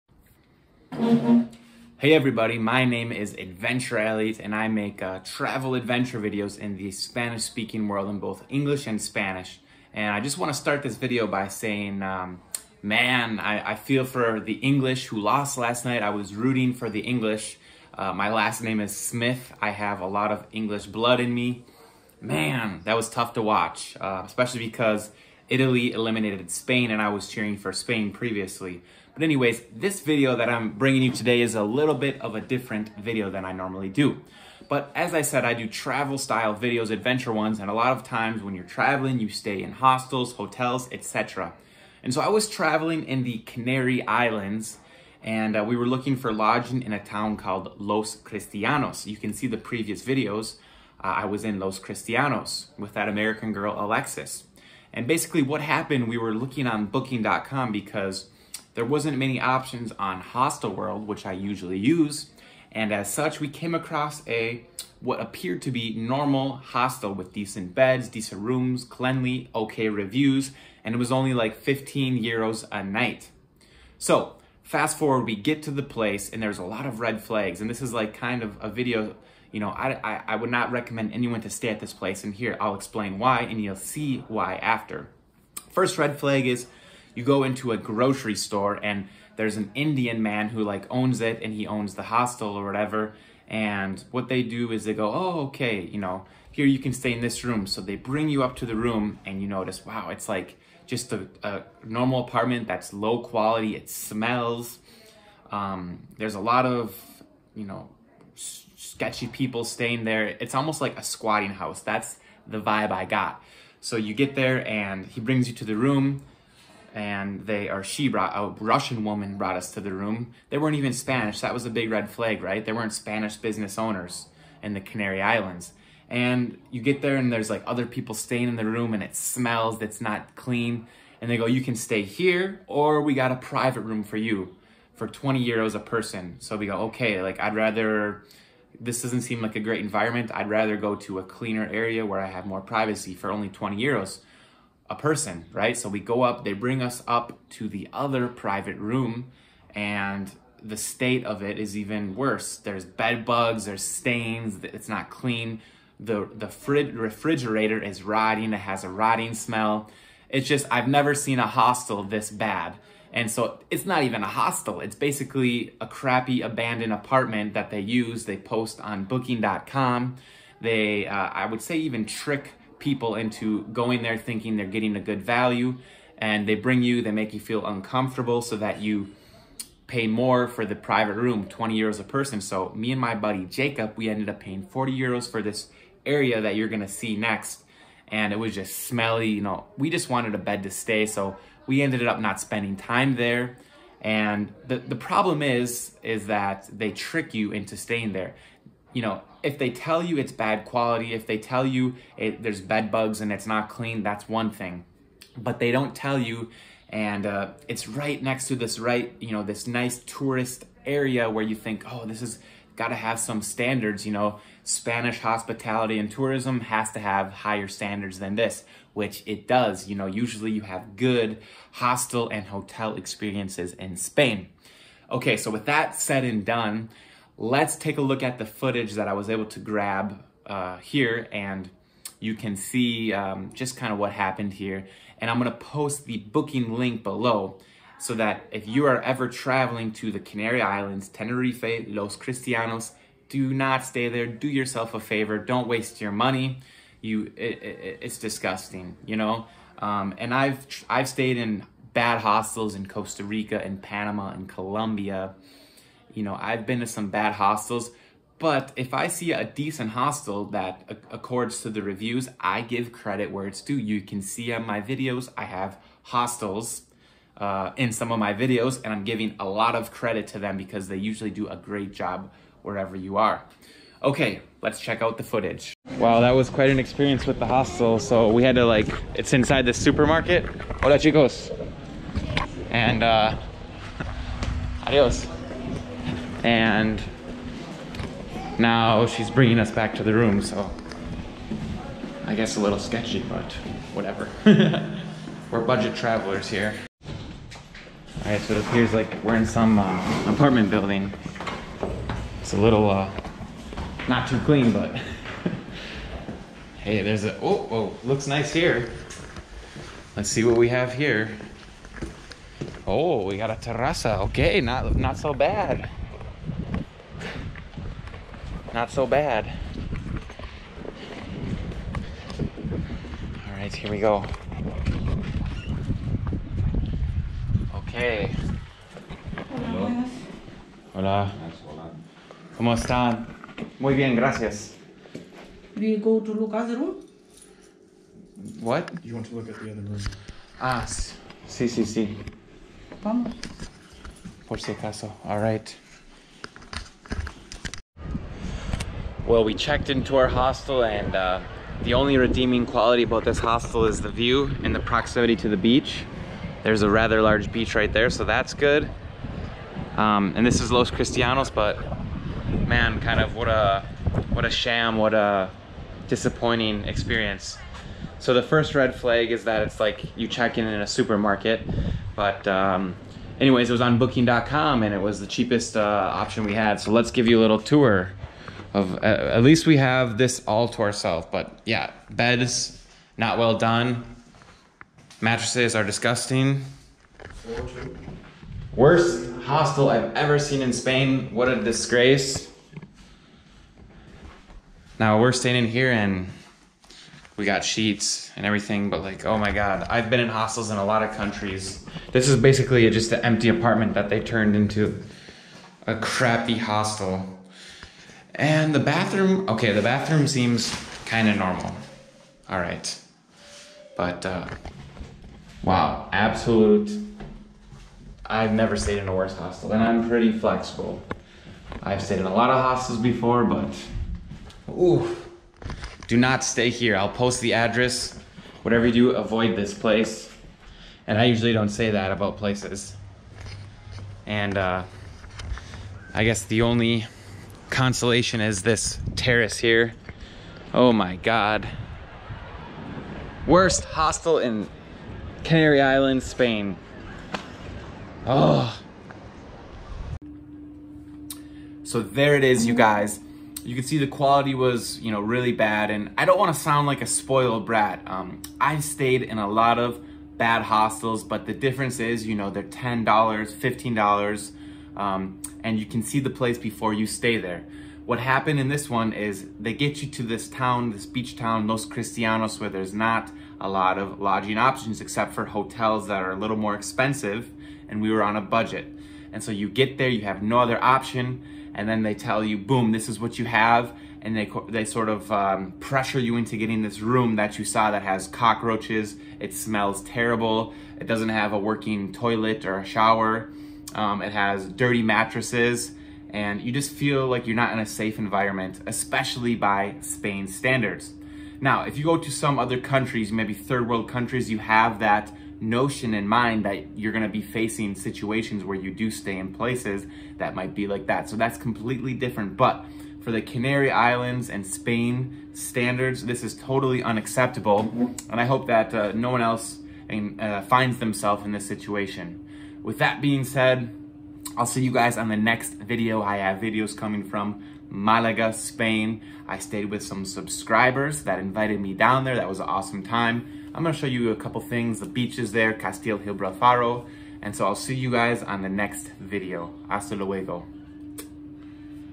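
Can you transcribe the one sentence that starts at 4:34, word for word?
Okay, let's check out the footage.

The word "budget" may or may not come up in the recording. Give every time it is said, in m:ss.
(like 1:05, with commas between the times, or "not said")
4:55, 7:58.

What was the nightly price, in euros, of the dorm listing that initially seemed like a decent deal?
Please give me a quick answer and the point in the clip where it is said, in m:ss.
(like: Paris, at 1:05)
15 euros, at 1:11.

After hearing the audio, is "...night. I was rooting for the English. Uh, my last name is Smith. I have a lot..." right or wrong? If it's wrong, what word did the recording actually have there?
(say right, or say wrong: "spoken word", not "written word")
right.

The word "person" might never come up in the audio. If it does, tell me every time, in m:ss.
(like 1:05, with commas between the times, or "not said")
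2:15, 2:24, 3:02.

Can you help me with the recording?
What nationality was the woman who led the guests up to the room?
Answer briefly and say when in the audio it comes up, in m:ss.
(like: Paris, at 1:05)
Russian, at 1:58.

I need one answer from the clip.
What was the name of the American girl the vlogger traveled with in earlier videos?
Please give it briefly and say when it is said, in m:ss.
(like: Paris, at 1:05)
Alexis, at 0:53.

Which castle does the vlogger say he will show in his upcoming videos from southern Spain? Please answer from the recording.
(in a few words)
Castillo Gibralfaro.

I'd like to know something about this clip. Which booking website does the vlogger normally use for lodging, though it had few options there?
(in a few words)
Hostelworld.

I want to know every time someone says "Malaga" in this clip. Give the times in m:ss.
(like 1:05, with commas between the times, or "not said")
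8:47.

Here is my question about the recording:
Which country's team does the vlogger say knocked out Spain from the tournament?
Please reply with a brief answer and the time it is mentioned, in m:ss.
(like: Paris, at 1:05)
Italy, at 0:25.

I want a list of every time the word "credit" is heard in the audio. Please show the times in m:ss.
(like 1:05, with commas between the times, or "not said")
4:22, 4:29.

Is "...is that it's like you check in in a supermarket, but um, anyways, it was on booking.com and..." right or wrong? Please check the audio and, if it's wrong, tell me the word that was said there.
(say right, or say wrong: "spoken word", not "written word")
right.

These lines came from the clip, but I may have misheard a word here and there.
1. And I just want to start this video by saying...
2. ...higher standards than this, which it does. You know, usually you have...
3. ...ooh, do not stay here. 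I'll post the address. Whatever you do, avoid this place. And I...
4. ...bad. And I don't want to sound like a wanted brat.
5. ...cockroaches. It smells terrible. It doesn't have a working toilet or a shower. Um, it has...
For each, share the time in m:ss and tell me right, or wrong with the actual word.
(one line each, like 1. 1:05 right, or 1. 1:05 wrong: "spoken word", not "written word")
1. 0:09 right
2. 3:37 right
3. 7:04 right
4. 7:35 wrong: "spoiled", not "wanted"
5. 8:08 right.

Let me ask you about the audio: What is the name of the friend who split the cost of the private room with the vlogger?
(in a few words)
Jacob.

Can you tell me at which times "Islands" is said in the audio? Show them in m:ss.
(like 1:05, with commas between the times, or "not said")
0:44, 2:05, 4:00, 7:25, 8:33.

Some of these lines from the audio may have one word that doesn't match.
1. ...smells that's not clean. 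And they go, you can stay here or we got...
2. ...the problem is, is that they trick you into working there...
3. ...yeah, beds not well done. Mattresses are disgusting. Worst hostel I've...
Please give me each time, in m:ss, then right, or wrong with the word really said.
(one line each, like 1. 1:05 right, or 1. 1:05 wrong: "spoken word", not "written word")
1. 2:09 right
2. 3:14 wrong: "staying", not "working"
3. 6:21 right.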